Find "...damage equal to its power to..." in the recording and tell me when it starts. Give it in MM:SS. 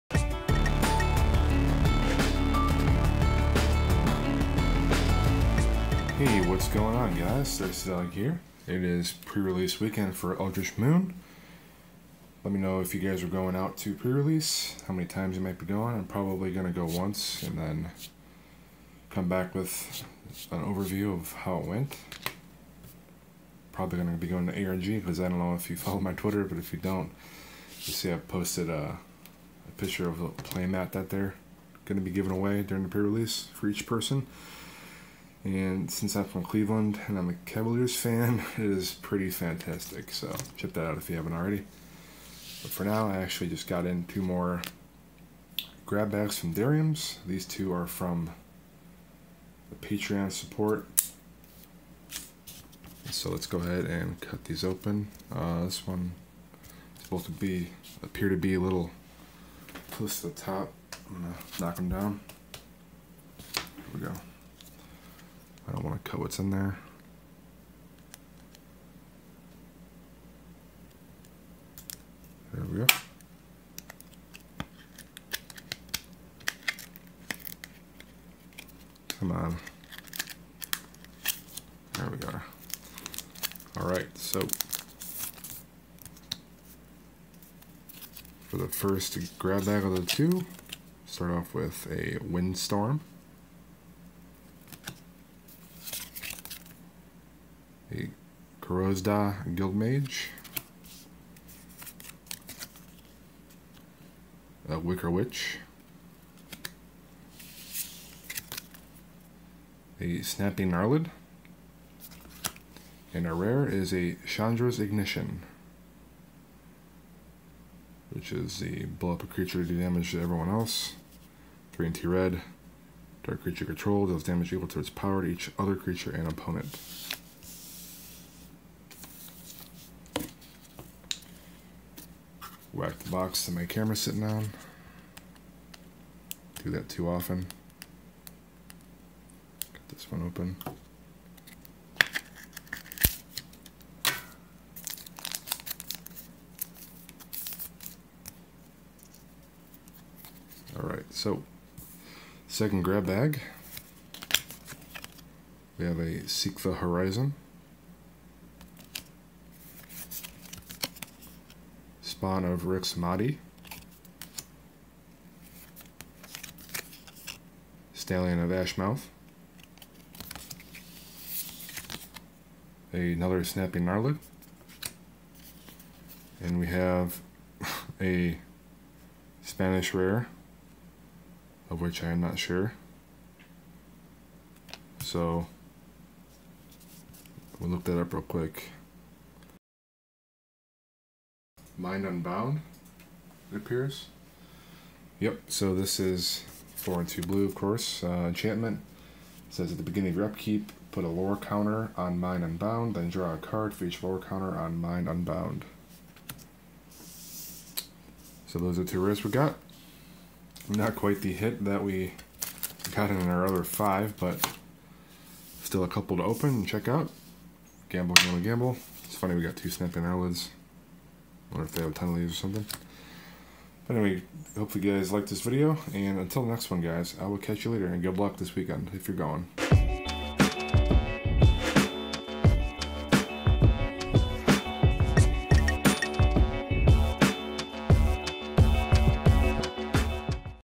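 02:04.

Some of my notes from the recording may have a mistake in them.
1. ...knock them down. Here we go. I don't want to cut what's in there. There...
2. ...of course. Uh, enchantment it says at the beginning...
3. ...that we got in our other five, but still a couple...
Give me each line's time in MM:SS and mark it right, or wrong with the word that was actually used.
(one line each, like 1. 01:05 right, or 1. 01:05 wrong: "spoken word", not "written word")
1. 01:01 right
2. 03:17 right
3. 03:31 right.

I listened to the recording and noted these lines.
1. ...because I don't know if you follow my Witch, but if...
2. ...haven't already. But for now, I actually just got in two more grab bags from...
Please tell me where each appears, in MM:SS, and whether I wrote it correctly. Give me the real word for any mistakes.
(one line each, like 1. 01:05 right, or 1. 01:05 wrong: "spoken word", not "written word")
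1. 00:24 wrong: "Twitter", not "Witch"
2. 00:41 right.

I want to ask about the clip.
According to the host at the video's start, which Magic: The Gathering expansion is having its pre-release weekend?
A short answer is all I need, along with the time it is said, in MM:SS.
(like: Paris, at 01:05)
Eldritch Moon, at 00:10.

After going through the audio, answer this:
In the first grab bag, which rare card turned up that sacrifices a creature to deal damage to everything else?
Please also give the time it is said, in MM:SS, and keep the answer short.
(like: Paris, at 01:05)
Chandra's Ignition, at 01:54.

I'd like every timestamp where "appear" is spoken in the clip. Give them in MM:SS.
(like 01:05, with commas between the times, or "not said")
00:58, 03:13.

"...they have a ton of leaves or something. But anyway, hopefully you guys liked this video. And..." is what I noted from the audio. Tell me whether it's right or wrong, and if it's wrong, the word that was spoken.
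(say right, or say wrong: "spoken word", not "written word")
right.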